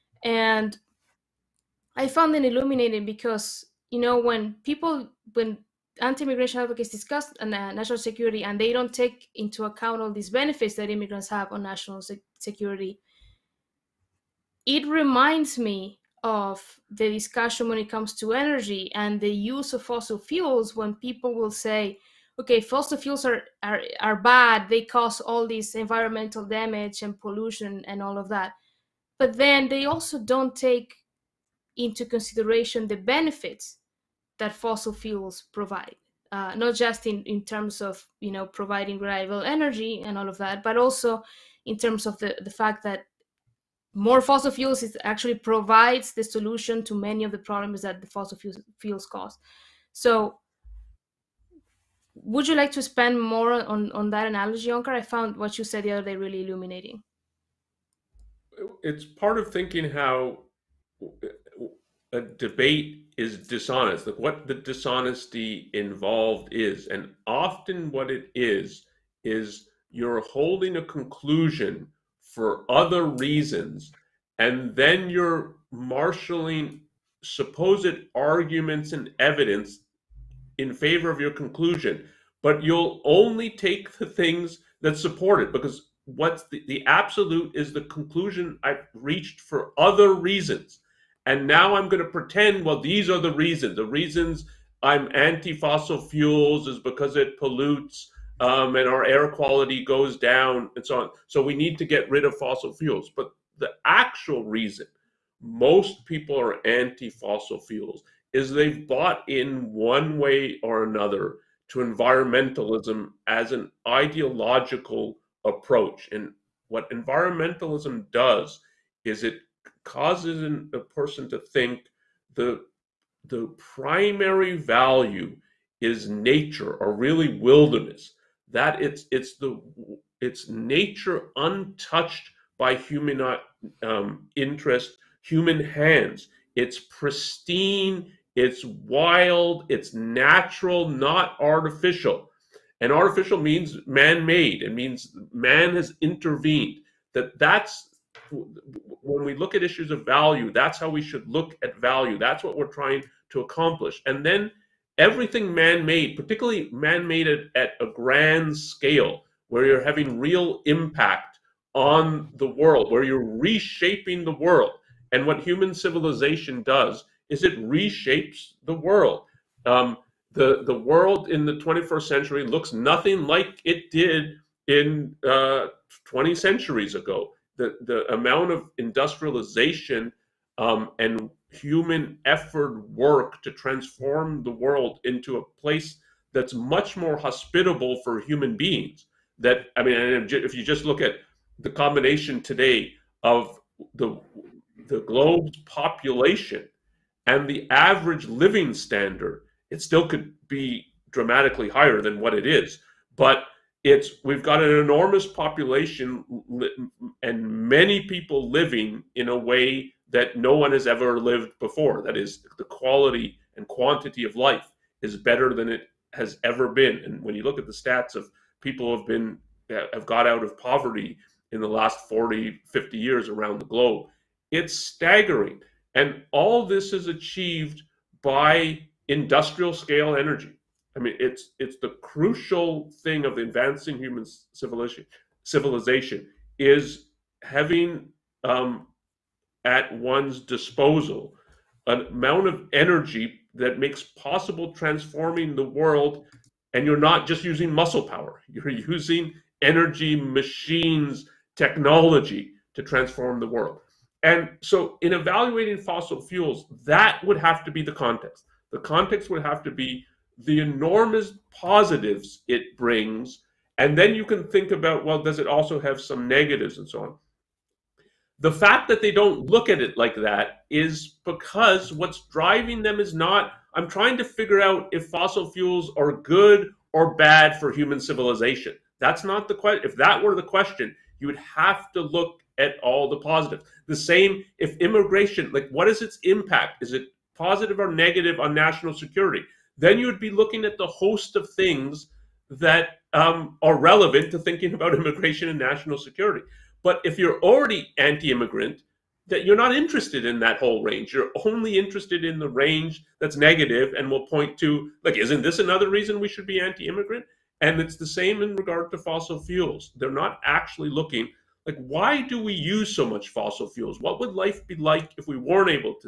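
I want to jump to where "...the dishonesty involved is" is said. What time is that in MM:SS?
01:04.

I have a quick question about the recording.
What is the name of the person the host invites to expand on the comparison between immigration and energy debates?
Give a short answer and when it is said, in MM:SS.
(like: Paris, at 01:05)
Onkar, at 00:54.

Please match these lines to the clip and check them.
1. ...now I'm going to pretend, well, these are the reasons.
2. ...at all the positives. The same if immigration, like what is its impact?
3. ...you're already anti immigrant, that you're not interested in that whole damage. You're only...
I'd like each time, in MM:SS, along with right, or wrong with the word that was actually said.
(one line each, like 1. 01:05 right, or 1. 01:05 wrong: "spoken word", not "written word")
1. 01:31 right
2. 04:42 right
3. 04:57 wrong: "range", not "damage".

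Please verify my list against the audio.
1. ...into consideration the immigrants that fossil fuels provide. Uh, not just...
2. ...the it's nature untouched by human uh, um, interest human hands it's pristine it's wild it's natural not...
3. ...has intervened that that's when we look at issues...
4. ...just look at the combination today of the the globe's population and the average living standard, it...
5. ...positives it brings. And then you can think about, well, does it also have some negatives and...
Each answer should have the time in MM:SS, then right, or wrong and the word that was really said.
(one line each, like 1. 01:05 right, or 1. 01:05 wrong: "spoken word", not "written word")
1. 00:31 wrong: "benefits", not "immigrants"
2. 02:09 right
3. 02:25 right
4. 03:10 right
5. 04:21 right.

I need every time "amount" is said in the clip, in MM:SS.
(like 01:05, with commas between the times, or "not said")
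02:58, 04:02.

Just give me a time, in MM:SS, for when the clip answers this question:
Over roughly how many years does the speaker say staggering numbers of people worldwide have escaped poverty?
03:42.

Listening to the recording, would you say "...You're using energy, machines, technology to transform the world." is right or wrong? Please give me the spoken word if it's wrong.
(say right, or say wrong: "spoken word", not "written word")
right.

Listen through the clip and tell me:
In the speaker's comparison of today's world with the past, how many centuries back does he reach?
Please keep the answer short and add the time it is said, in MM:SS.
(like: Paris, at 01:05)
20 centuries, at 02:56.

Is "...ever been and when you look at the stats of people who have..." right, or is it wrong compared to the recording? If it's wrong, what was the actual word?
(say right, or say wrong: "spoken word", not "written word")
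right.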